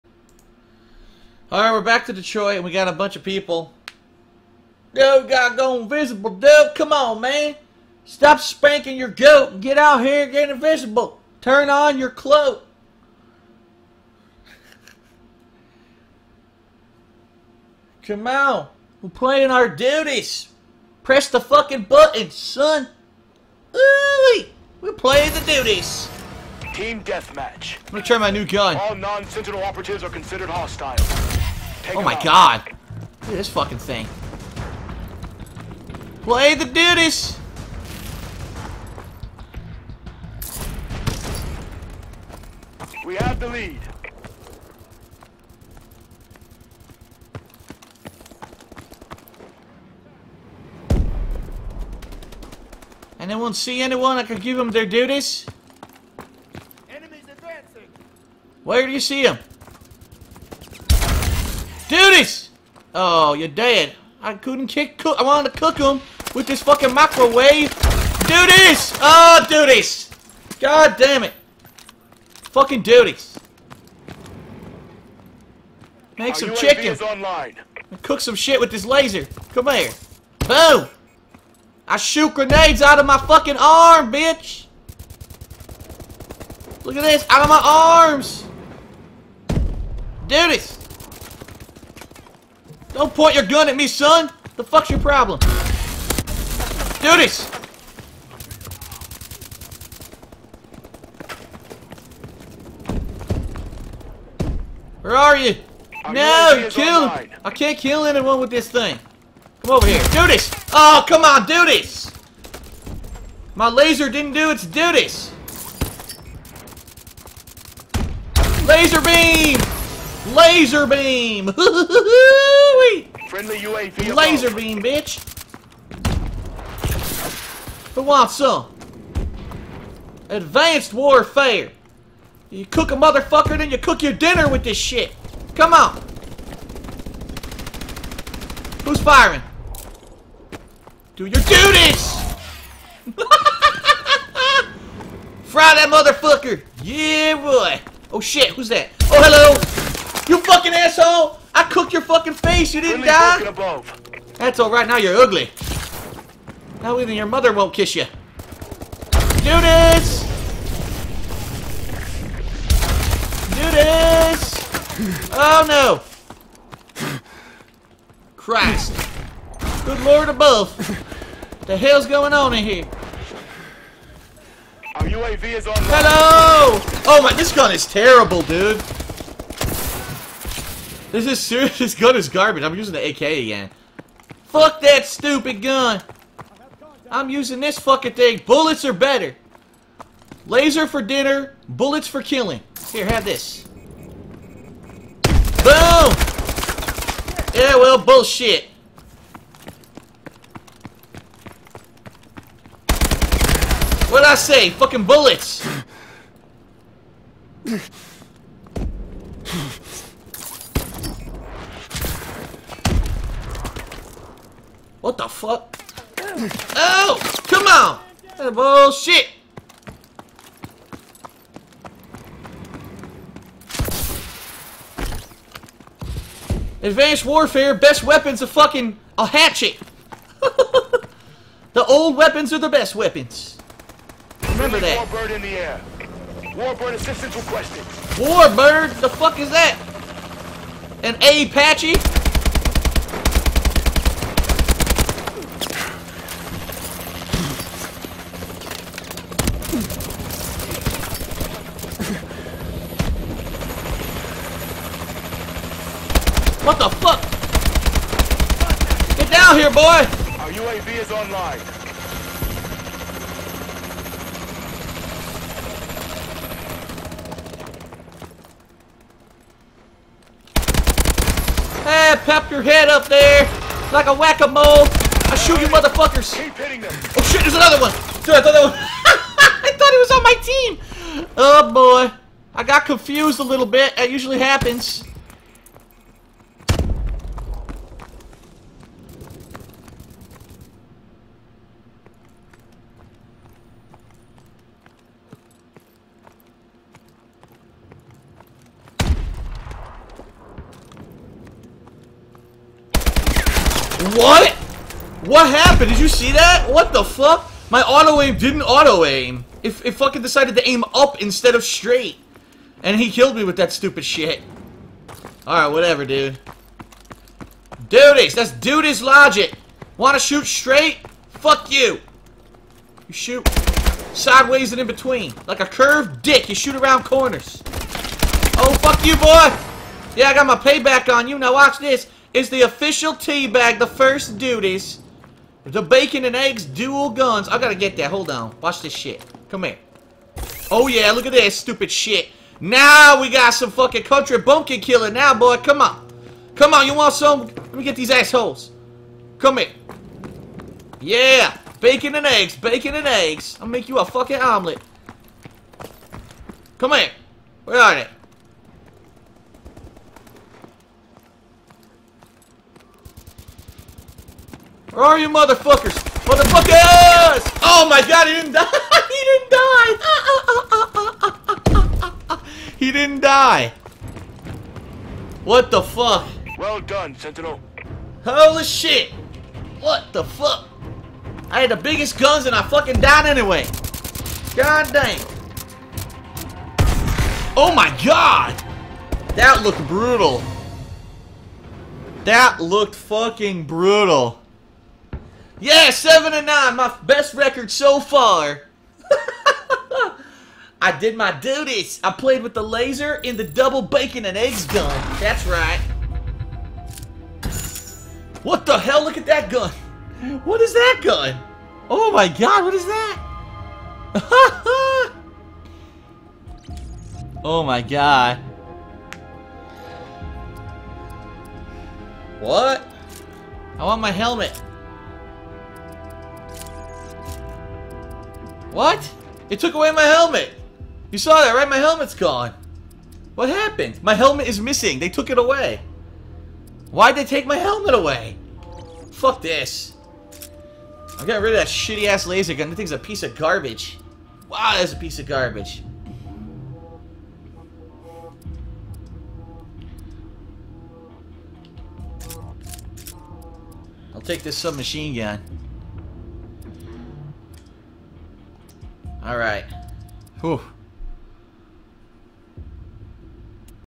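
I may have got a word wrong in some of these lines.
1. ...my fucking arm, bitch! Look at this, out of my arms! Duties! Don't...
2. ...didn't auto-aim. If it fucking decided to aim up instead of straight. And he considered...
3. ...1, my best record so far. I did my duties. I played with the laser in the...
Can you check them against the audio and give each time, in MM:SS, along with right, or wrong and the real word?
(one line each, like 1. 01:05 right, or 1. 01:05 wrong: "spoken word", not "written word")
1. 01:23 right
2. 05:08 wrong: "killed", not "considered"
3. 06:36 wrong: "9", not "1".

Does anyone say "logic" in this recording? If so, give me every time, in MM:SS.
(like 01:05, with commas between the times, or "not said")
05:19.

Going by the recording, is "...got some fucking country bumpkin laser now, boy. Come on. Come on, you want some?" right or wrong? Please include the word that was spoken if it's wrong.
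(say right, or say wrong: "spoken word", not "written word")
wrong: "killer", not "laser".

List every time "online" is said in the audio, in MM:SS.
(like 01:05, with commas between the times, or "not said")
01:17, 01:47, 04:21.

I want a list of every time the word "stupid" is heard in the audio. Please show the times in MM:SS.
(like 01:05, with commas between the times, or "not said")
03:05, 05:13, 05:41.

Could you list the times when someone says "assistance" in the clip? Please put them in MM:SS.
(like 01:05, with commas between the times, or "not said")
03:56.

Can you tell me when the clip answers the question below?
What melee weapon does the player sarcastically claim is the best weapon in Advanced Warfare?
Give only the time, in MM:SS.
03:49.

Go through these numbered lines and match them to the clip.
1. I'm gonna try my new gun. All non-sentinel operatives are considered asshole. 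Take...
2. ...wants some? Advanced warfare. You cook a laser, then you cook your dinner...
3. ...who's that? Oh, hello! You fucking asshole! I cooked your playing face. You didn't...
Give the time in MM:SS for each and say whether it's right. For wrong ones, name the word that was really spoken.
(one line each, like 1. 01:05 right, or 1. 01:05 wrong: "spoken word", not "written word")
1. 00:27 wrong: "hostile", not "asshole"
2. 02:08 wrong: "motherfucker", not "laser"
3. 02:28 wrong: "fucking", not "playing".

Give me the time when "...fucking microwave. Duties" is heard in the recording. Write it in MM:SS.
01:06.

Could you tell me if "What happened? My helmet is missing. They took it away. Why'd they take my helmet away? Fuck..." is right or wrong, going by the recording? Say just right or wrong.
right.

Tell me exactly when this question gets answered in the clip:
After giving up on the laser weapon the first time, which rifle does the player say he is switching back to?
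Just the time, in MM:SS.
03:03.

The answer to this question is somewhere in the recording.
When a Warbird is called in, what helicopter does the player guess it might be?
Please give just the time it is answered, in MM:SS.
04:01.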